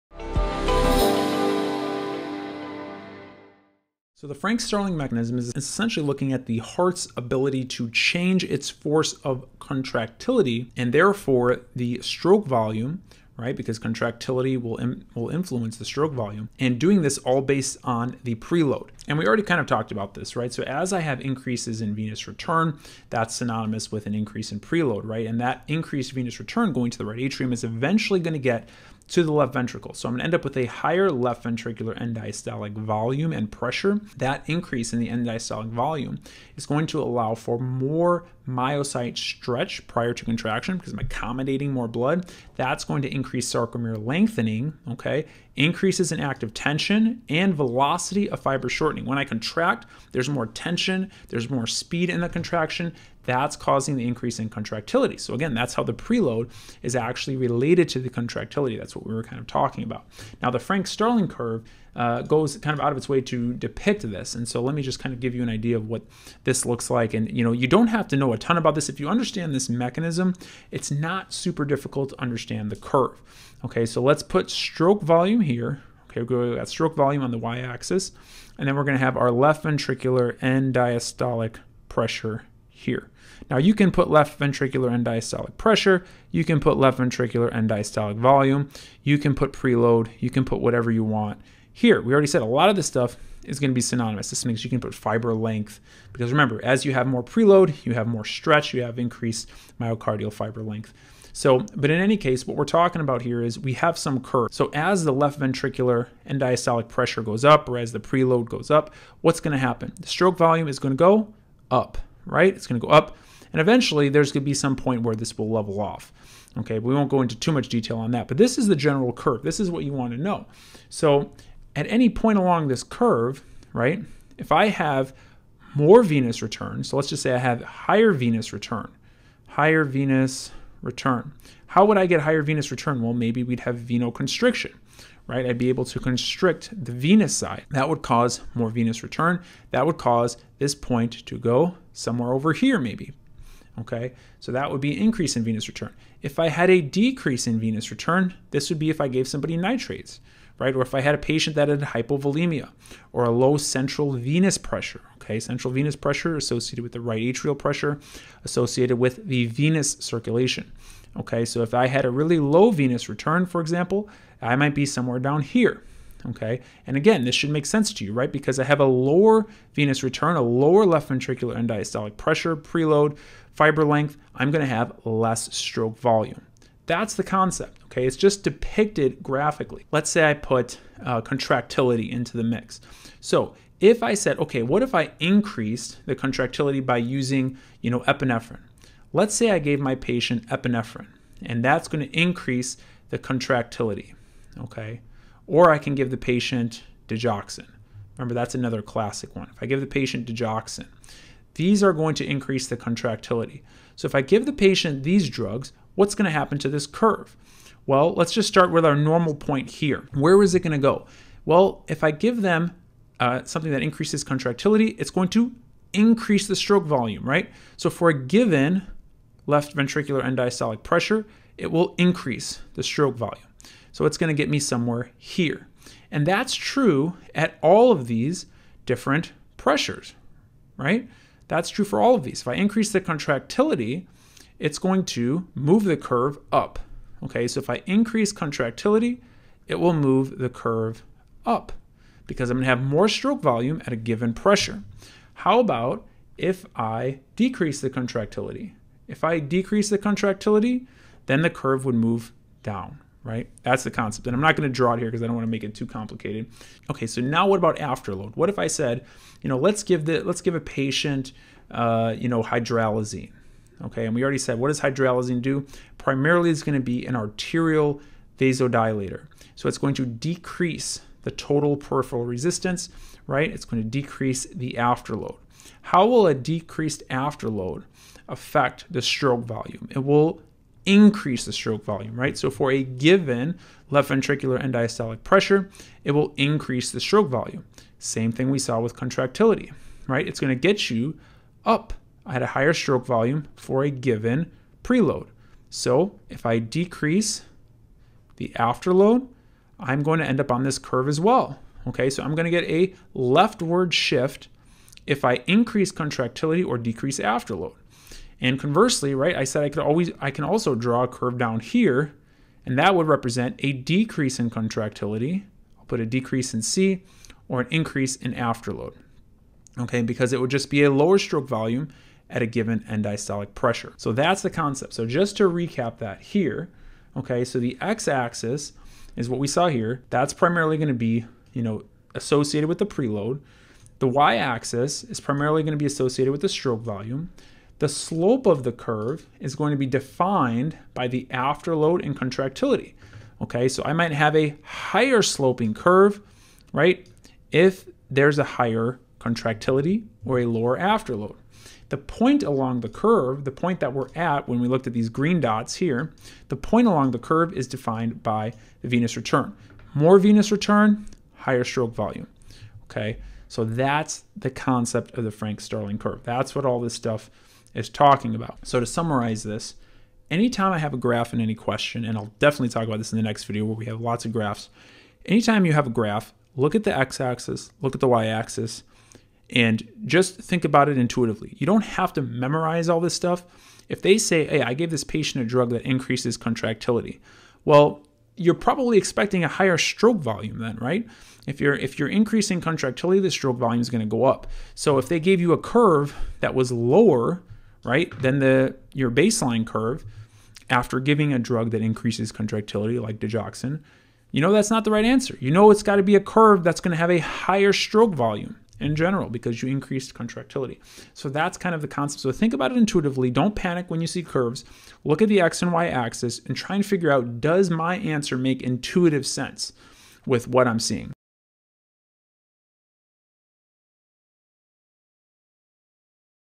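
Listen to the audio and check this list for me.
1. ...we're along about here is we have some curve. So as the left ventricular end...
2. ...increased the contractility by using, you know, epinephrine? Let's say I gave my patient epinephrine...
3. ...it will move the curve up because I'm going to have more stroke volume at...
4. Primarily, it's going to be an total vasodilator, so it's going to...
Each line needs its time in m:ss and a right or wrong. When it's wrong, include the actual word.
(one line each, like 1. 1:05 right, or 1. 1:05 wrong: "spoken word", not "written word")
1. 1:42 wrong: "talking", not "along"
2. 3:05 right
3. 3:59 right
4. 4:25 wrong: "arterial", not "total".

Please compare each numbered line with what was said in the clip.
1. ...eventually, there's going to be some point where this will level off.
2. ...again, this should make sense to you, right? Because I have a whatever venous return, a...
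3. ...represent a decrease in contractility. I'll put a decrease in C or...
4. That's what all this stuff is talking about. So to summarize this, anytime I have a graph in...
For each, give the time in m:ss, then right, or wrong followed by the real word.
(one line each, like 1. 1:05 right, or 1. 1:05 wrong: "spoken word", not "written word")
1. 1:53 right
2. 2:46 wrong: "lower", not "whatever"
3. 5:13 right
4. 6:06 right.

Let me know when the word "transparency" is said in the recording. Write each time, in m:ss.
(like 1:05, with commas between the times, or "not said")
not said.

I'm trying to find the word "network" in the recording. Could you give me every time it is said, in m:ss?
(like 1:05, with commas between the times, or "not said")
not said.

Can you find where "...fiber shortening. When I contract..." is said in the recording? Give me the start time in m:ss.
0:48.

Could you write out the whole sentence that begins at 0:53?
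That's causing the increase in contractility.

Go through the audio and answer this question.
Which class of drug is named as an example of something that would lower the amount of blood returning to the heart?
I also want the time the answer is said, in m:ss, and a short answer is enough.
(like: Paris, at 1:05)
Nitrates, at 2:29.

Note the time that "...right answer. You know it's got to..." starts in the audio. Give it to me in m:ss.
6:44.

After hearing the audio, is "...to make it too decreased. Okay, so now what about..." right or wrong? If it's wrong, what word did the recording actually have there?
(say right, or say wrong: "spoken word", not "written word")
wrong: "complicated", not "decreased".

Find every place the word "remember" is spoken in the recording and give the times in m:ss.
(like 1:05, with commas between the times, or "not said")
1:36, 3:18.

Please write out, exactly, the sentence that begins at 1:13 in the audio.
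Okay, so let's put stroke volume here.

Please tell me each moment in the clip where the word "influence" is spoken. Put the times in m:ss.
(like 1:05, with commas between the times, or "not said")
0:15.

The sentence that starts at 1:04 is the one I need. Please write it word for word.
And so let me just kind of give you an idea of what this looks like.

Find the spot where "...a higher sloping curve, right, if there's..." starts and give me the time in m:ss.
5:44.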